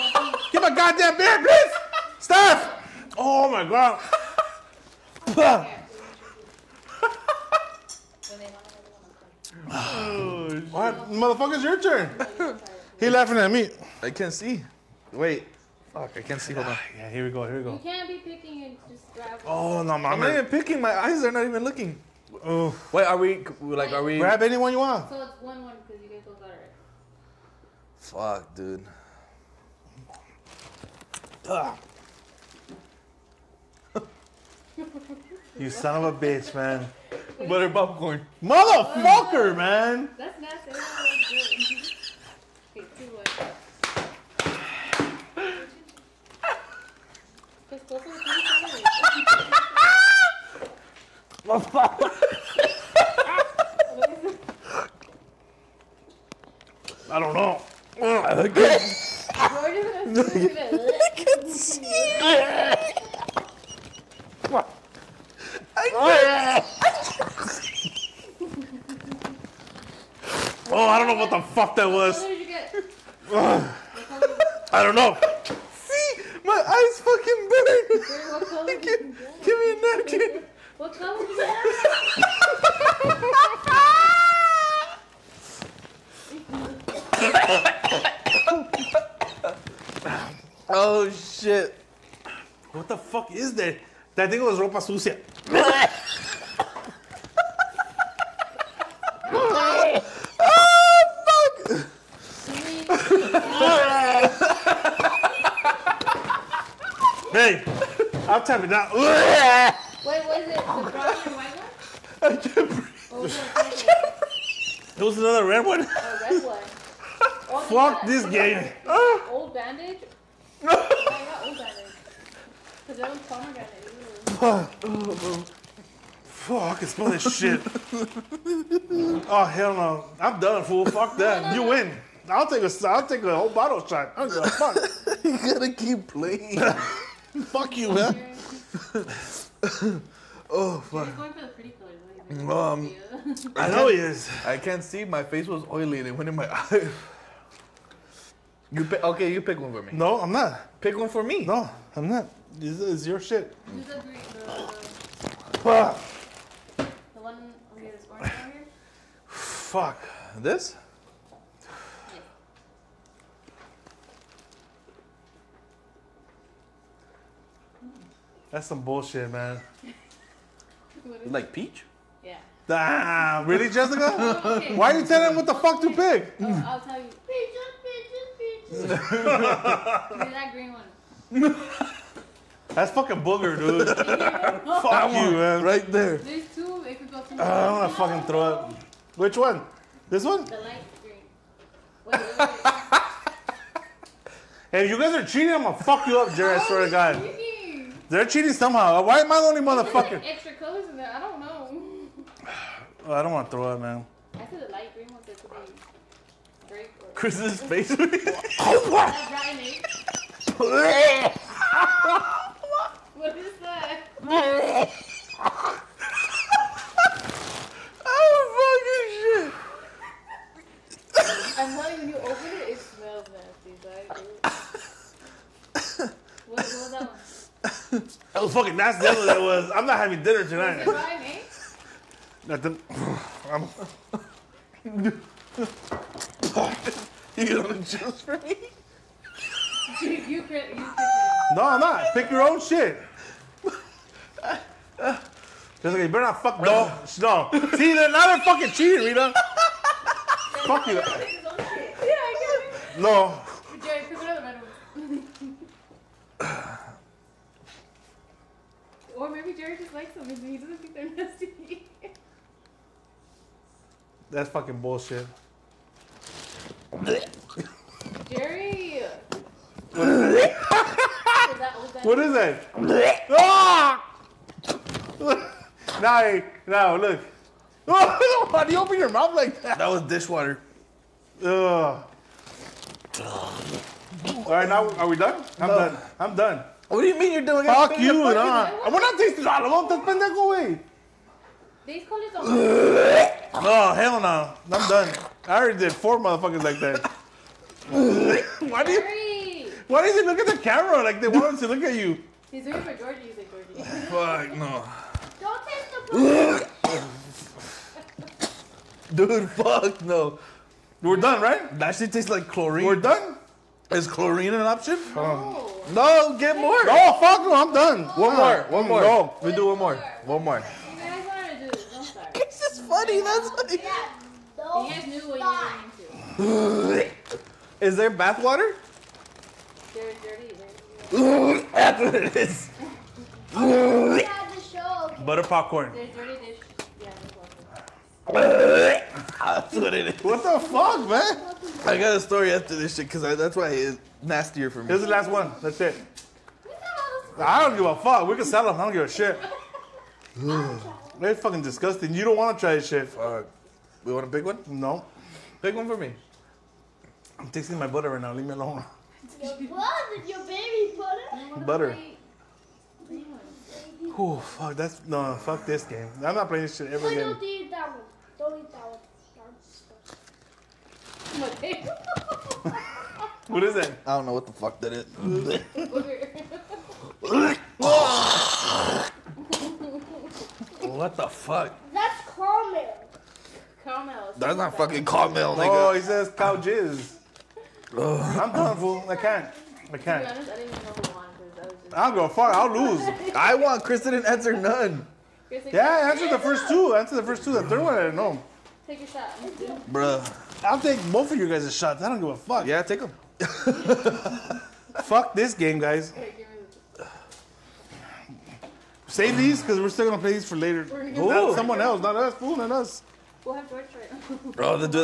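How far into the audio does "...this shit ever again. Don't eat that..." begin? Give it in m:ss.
6:06.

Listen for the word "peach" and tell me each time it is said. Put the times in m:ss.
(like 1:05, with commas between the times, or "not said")
2:51, 2:57.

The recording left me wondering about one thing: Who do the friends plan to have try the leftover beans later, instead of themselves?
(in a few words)
George.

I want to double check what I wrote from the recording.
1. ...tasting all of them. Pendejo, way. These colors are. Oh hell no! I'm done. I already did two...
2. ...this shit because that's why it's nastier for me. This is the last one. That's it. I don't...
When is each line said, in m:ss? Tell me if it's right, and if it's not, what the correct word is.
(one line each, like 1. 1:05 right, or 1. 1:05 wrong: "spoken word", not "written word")
1. 4:49 wrong: "four", not "two"
2. 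5:42 right.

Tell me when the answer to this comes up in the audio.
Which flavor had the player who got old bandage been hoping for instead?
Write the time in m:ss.
2:03.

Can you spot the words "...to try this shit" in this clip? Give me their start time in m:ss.
5:52.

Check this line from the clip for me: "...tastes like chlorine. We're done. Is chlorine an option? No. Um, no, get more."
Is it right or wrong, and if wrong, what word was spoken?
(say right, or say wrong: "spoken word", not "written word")
right.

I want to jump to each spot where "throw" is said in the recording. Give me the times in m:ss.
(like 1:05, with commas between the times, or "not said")
3:08, 3:23.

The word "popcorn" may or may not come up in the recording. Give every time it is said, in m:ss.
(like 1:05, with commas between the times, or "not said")
0:37, 5:35.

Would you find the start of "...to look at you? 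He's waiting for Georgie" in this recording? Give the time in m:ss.
5:01.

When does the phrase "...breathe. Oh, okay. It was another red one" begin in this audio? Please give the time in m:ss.
1:52.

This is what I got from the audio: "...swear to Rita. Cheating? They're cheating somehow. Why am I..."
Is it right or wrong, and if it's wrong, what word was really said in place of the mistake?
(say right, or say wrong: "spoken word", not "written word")
wrong: "God", not "Rita".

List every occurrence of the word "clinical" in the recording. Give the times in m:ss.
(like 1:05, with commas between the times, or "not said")
not said.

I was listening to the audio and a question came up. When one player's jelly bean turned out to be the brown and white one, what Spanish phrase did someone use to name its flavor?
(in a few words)
ropa sucia.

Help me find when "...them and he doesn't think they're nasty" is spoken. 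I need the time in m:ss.
4:20.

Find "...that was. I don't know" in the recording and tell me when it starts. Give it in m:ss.
1:11.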